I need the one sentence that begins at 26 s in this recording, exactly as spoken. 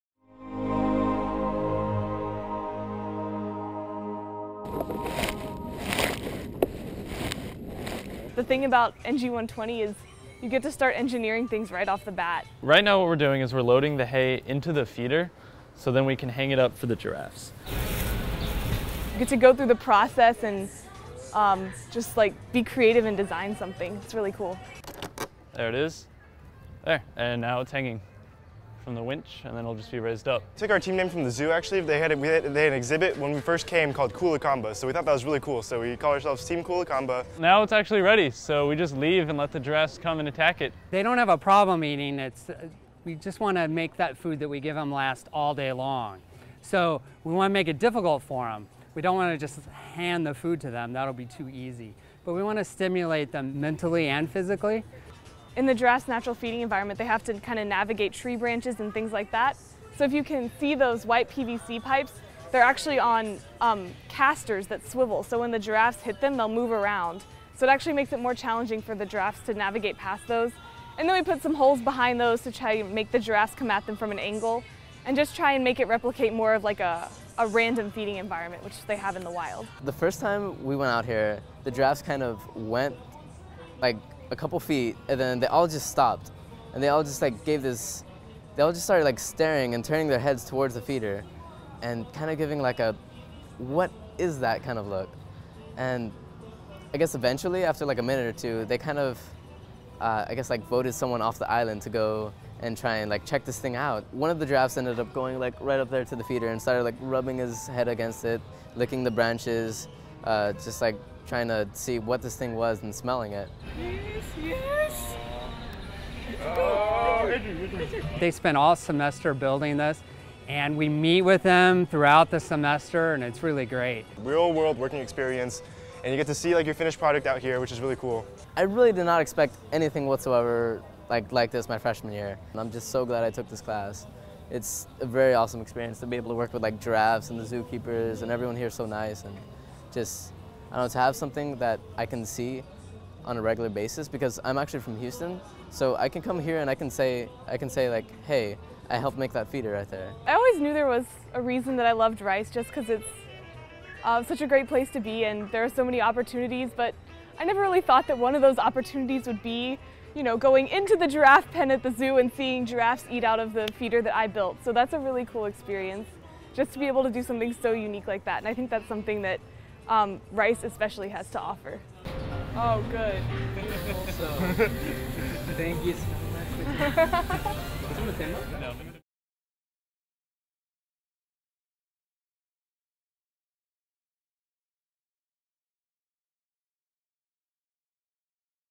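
There, and now it's hanging from the winch and then it'll just be raised up.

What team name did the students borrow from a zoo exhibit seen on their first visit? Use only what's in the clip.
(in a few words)
Team Kulakamba.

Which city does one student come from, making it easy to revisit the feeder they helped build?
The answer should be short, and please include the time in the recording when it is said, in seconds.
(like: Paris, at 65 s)
Houston, at 144 s.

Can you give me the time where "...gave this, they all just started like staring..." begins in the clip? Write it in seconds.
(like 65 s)
87 s.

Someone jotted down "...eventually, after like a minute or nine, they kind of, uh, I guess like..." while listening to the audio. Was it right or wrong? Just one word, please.
wrong.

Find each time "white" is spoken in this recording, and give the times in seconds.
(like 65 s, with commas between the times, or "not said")
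61 s.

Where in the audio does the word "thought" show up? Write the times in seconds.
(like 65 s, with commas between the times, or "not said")
34 s, 157 s.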